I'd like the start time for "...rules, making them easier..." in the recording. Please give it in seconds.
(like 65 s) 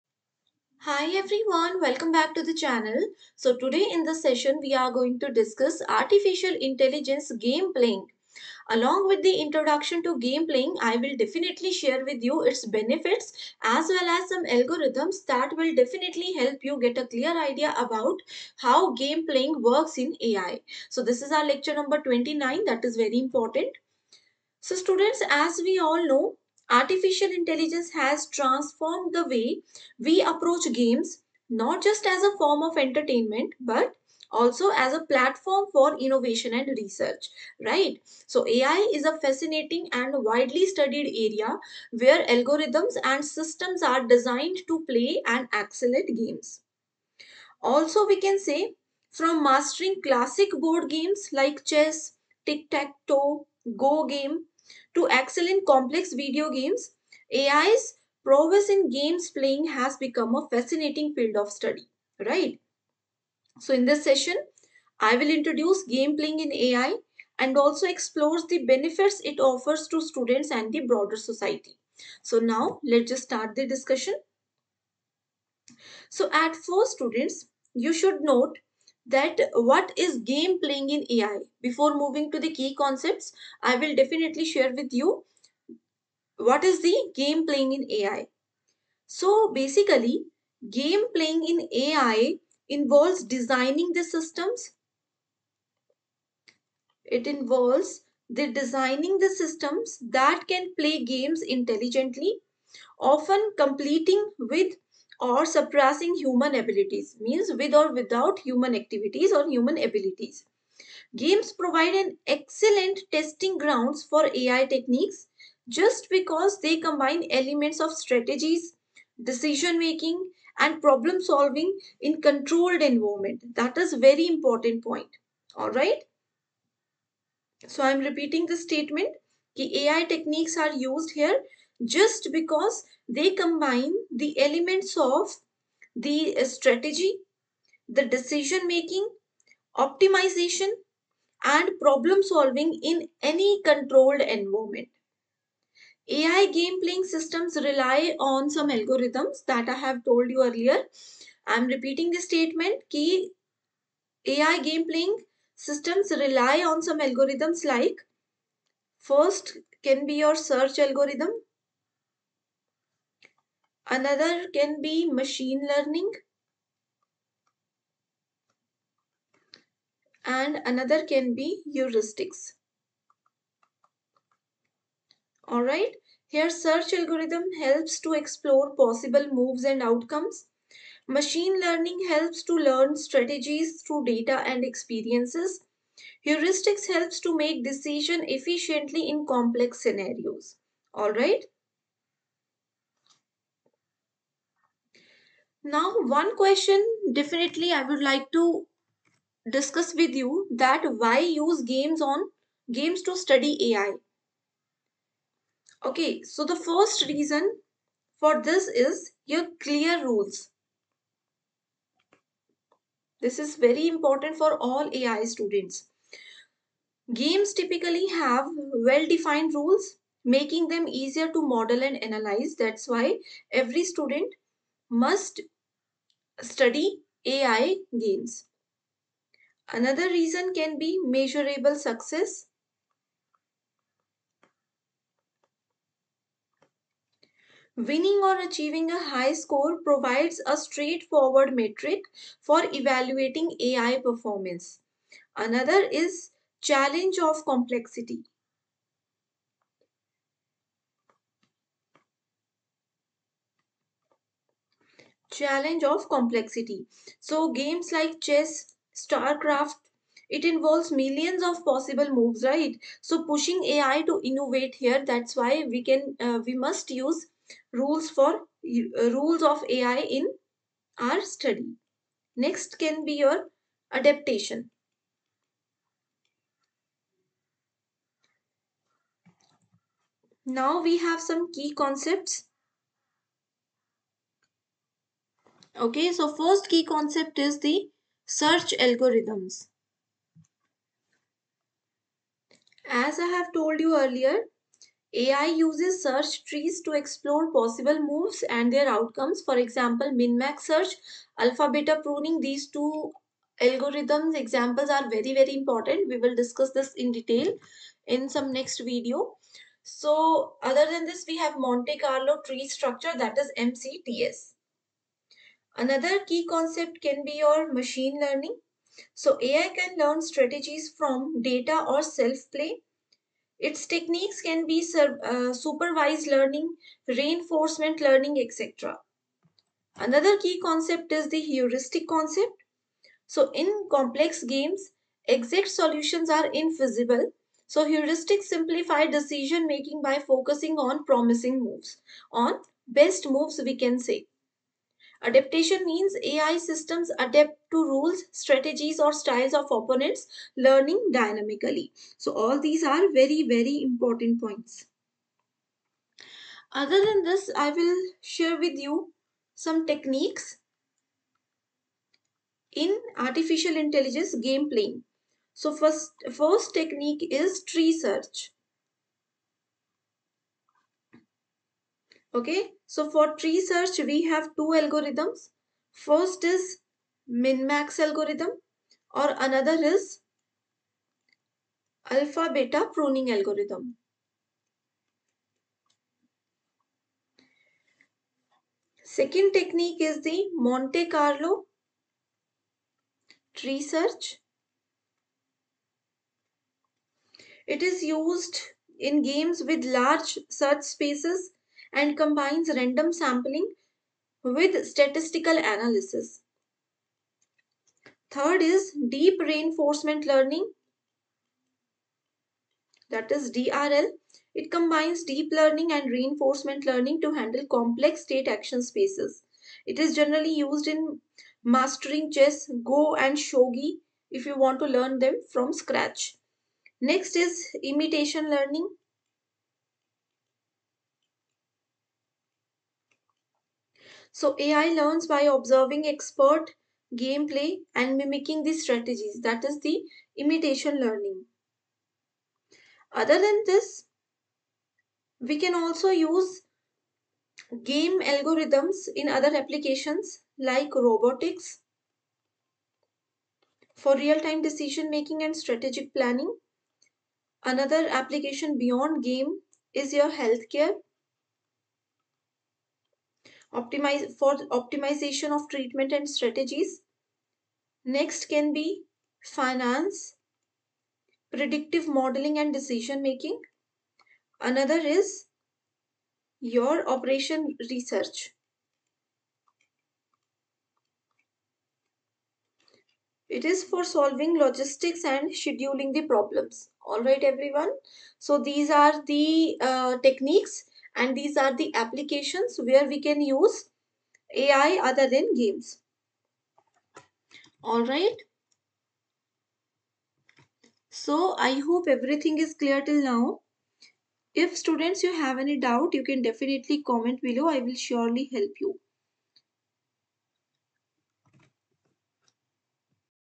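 219 s.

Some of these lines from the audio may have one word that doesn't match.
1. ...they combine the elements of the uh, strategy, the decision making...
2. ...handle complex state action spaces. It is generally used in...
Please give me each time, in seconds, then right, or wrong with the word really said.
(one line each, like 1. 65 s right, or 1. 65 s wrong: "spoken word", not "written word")
1. 133 s right
2. 417 s right.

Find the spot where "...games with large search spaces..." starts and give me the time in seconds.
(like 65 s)
399 s.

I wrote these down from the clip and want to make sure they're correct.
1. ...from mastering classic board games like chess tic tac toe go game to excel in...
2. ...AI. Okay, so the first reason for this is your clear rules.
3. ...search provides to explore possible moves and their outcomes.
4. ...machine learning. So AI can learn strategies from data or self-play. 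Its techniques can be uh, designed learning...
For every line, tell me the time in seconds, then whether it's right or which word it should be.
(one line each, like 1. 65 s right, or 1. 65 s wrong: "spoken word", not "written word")
1. 49 s right
2. 203 s right
3. 296 s wrong: "trees", not "provides"
4. 317 s wrong: "supervised", not "designed".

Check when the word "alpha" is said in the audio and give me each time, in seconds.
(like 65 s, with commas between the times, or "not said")
301 s, 382 s.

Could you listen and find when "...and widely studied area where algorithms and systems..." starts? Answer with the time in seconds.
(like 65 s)
39 s.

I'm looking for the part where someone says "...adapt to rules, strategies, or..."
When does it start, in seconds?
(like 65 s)
347 s.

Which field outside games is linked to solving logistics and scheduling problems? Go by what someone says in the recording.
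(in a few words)
Operation research.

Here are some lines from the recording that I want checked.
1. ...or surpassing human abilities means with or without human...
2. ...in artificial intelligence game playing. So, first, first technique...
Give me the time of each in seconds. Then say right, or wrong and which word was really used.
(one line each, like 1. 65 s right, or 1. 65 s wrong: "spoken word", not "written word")
1. 105 s right
2. 362 s right.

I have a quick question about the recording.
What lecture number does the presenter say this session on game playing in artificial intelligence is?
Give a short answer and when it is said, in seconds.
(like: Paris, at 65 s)
29, at 21 s.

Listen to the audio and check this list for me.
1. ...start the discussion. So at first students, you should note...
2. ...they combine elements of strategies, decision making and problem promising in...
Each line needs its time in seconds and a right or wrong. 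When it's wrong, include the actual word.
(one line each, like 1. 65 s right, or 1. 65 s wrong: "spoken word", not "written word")
1. 73 s right
2. 116 s wrong: "solving", not "promising".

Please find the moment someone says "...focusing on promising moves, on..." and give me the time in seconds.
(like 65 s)
340 s.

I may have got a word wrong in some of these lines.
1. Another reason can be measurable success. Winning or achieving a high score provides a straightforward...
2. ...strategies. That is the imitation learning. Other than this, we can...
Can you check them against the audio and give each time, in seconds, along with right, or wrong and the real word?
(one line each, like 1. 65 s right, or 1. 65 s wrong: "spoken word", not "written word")
1. 229 s right
2. 438 s right.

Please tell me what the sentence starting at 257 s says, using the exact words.
So games like chess, StarCraft, it involves millions of possible moves, right?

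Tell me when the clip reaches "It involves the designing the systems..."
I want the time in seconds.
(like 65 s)
97 s.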